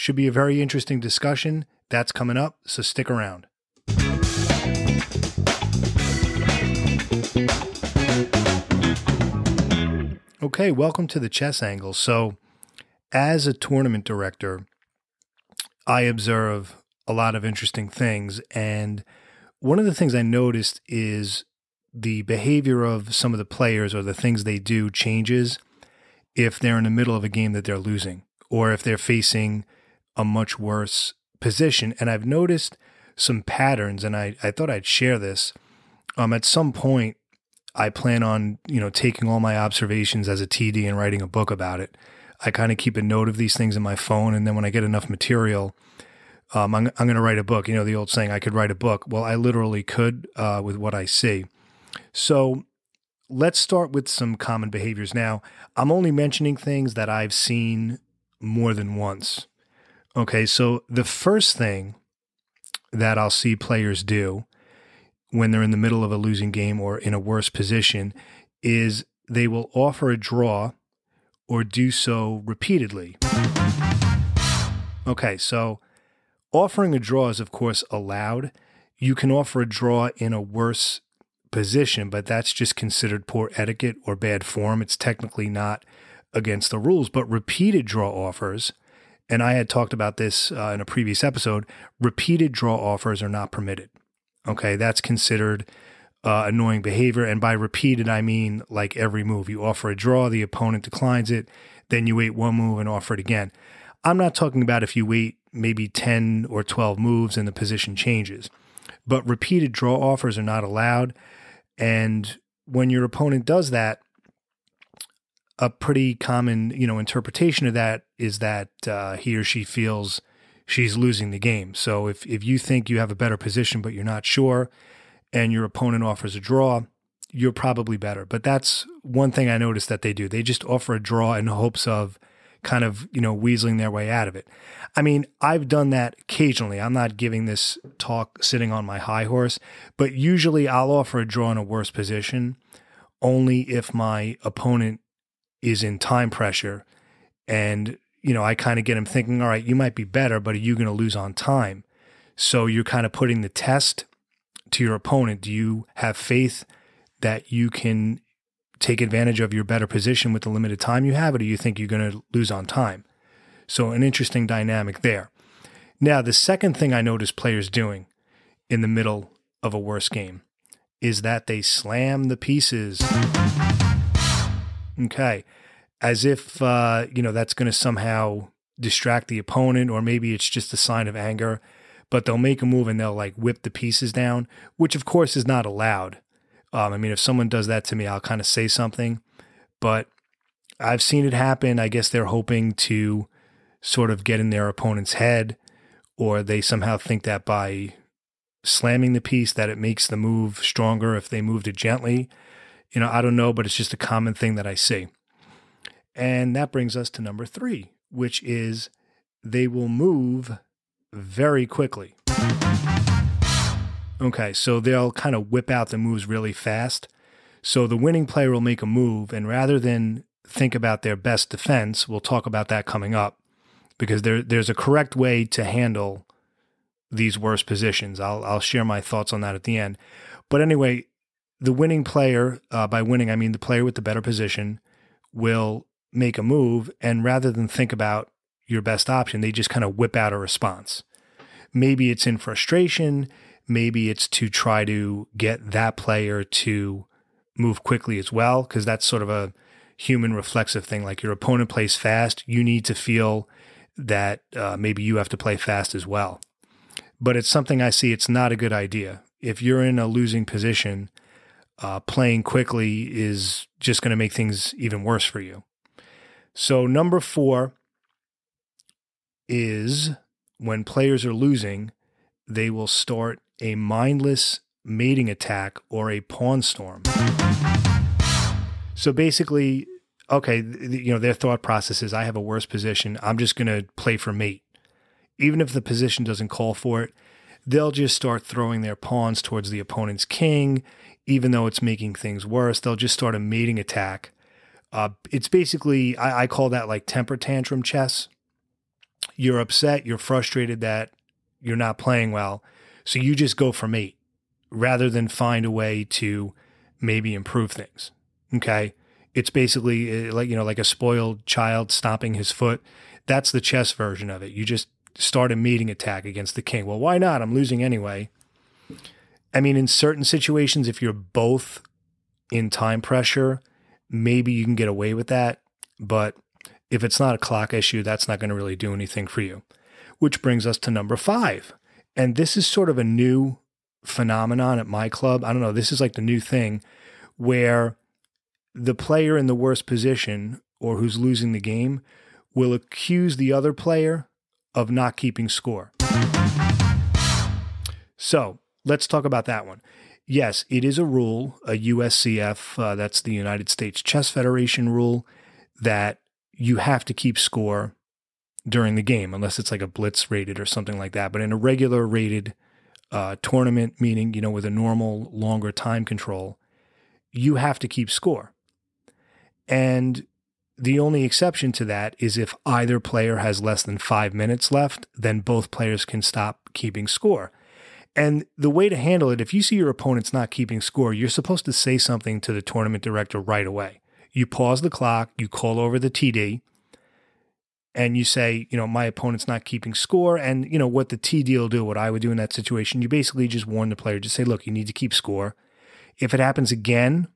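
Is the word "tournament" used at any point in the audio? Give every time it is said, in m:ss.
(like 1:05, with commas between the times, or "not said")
0:13, 6:03, 6:22.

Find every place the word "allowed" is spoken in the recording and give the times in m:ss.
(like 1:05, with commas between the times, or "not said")
1:17, 1:50, 3:05.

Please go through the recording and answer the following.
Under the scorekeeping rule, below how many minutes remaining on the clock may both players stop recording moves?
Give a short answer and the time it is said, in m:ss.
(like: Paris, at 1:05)
5, at 6:13.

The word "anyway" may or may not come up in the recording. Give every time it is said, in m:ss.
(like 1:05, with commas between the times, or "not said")
3:50, 5:17.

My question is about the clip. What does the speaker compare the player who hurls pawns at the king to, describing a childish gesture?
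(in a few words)
A spoiled child stomping his foot.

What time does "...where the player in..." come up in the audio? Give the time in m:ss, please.
5:37.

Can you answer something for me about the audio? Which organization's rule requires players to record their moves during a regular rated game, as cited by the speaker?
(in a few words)
United States Chess Federation.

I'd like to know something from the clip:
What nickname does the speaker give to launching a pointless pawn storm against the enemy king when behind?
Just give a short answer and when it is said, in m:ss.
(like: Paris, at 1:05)
Temper tantrum chess, at 4:57.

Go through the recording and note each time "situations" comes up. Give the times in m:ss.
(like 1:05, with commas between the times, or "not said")
5:20, 6:32.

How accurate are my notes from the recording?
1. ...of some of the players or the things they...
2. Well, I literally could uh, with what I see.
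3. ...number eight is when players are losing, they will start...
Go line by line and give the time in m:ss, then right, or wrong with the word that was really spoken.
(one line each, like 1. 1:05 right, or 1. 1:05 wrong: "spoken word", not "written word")
1. 0:22 right
2. 0:49 right
3. 4:26 wrong: "four", not "eight".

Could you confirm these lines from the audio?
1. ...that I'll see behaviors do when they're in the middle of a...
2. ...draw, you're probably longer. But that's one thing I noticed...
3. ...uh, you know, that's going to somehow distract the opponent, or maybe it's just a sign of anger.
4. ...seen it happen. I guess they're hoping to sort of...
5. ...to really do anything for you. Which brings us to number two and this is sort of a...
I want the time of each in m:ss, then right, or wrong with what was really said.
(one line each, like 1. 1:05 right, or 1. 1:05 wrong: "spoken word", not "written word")
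1. 1:02 wrong: "players", not "behaviors"
2. 2:06 wrong: "better", not "longer"
3. 2:56 right
4. 3:11 right
5. 5:28 wrong: "five", not "two".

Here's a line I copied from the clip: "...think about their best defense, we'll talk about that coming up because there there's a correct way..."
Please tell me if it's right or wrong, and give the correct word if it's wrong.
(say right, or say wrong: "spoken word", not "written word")
right.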